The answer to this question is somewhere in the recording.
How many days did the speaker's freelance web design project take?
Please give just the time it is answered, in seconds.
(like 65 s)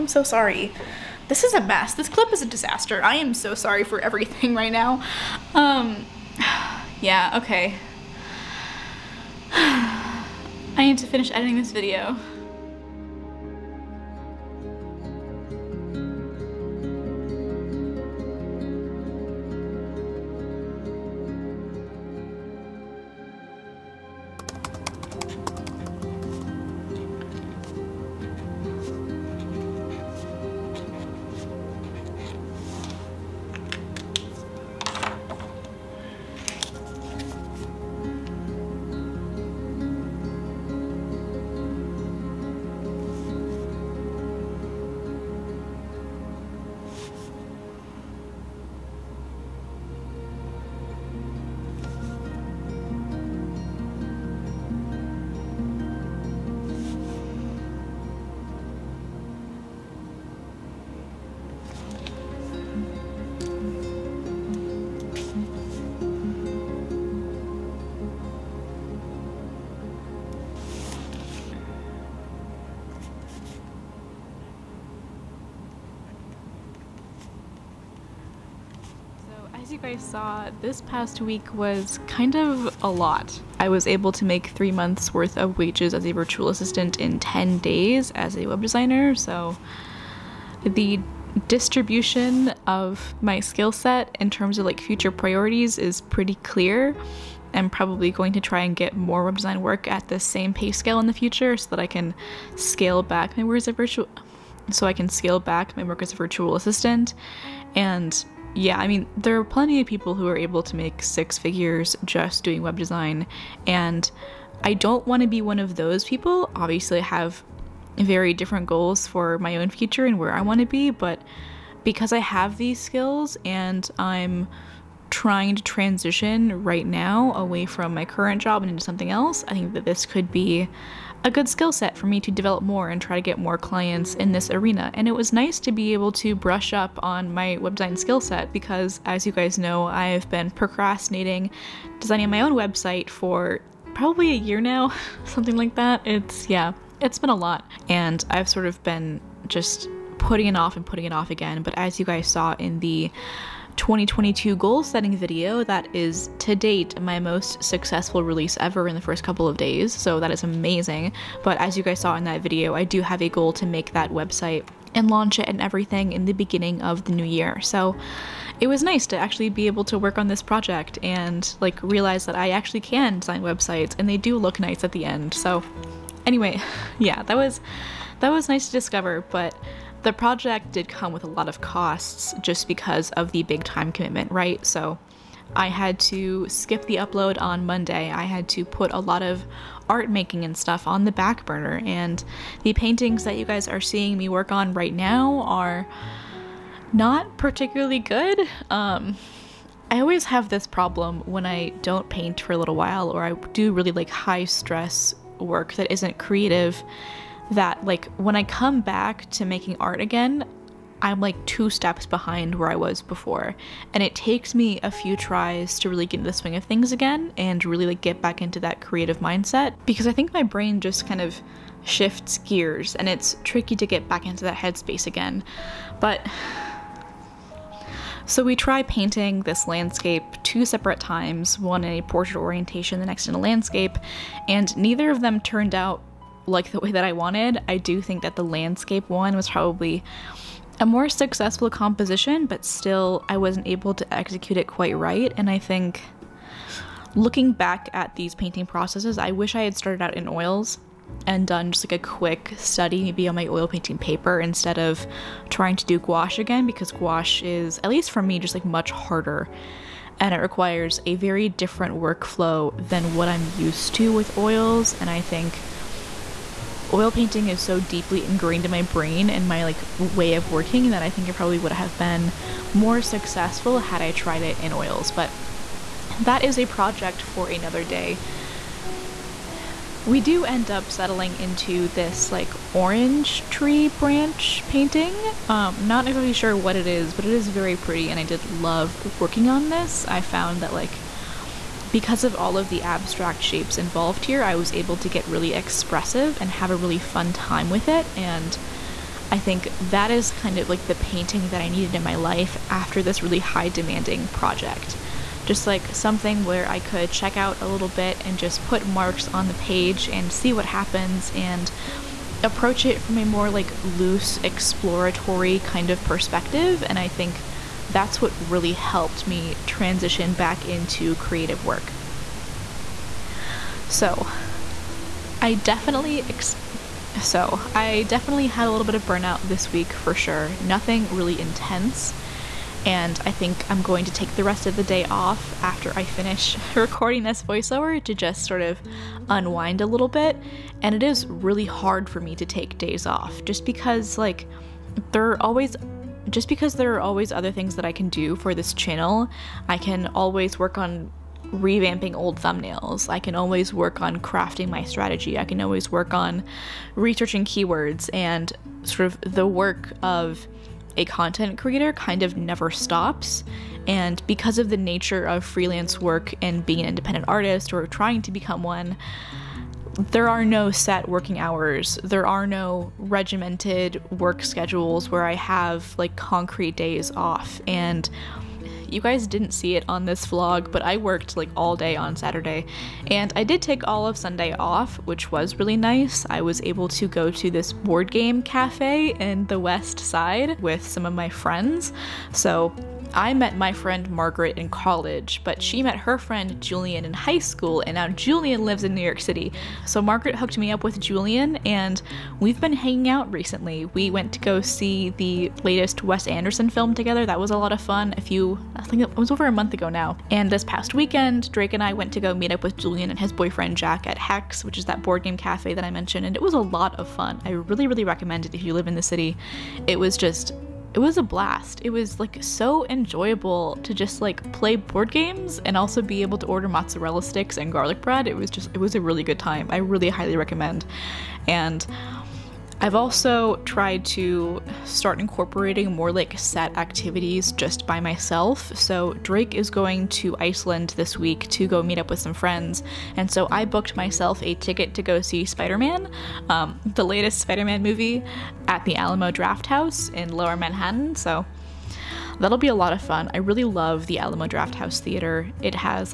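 87 s.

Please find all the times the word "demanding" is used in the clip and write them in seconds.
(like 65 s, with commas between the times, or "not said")
303 s.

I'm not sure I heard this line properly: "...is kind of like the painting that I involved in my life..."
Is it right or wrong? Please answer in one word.
wrong.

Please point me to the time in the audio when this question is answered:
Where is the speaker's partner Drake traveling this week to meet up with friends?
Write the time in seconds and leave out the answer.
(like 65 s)
440 s.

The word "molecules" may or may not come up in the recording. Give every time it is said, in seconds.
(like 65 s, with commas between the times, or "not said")
not said.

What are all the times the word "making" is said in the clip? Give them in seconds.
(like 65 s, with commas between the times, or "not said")
190 s, 209 s.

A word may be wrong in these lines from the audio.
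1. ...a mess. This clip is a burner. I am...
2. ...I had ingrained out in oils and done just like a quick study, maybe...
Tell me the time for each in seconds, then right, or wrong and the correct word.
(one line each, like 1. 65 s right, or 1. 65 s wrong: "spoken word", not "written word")
1. 1 s wrong: "disaster", not "burner"
2. 249 s wrong: "started", not "ingrained".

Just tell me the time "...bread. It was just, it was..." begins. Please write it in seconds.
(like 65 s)
427 s.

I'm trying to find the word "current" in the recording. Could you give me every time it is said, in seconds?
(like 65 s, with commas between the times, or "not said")
128 s.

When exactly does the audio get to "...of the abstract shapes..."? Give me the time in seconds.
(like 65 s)
292 s.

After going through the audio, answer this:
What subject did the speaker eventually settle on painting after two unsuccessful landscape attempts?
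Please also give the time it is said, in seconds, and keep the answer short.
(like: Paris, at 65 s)
orange tree branch, at 282 s.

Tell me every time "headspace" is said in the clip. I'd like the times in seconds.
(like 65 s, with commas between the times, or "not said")
224 s.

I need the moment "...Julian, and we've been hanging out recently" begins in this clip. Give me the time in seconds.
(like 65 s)
400 s.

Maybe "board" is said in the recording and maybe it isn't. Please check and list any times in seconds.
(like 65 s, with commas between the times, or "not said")
387 s, 415 s, 424 s.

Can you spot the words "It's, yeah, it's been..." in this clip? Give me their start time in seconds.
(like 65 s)
146 s.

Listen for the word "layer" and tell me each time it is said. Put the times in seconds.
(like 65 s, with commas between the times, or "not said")
not said.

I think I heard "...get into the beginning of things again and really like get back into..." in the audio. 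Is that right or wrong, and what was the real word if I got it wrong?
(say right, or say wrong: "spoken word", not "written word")
wrong: "swing", not "beginning".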